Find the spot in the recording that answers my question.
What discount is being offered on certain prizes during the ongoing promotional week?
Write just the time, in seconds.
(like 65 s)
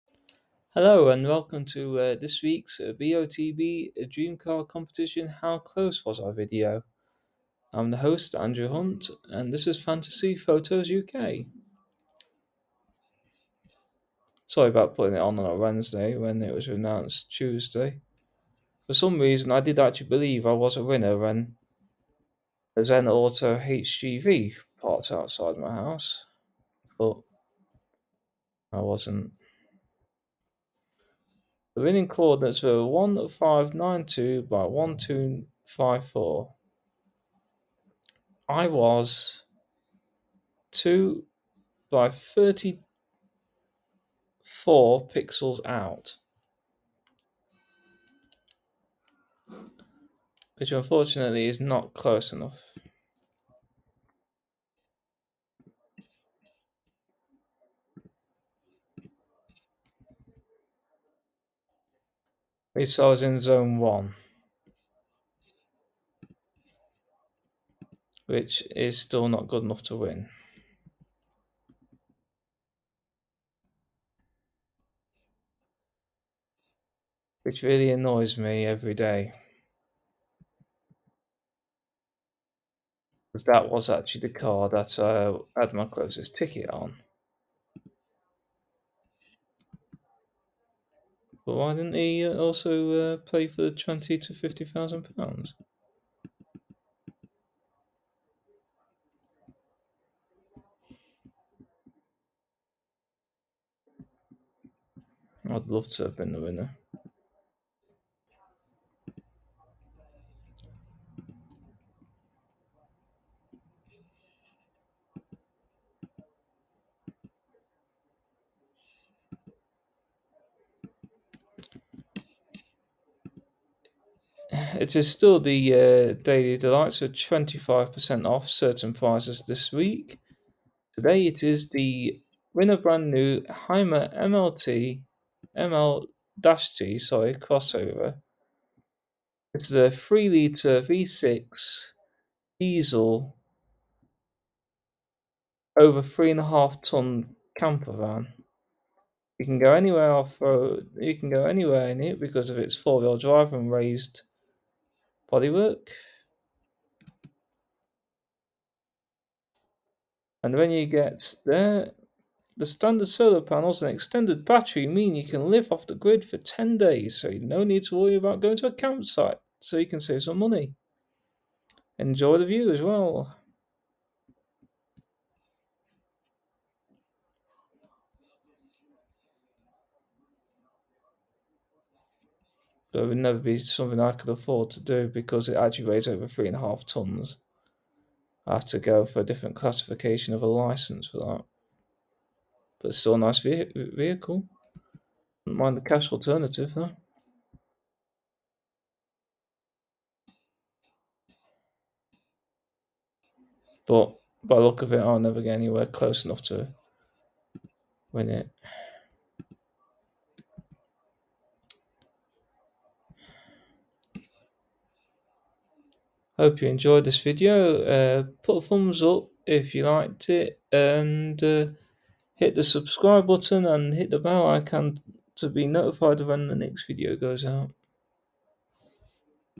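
127 s.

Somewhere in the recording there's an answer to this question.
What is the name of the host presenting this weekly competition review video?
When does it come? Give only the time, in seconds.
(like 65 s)
8 s.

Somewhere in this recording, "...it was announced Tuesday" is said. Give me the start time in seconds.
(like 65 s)
16 s.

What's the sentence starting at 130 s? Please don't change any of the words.
Today it is the winner brand new Hymer MLT ML-T sorry crossover.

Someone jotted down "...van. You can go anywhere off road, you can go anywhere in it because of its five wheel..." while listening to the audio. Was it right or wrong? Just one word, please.
wrong.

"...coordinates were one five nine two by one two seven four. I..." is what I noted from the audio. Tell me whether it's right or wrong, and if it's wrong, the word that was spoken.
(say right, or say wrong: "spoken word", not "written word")
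wrong: "five", not "seven".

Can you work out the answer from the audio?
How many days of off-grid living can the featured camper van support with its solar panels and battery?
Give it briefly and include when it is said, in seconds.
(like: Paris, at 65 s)
10 days, at 166 s.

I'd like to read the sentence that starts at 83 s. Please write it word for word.
Because that was actually the car that uh, I had my closest ticket on.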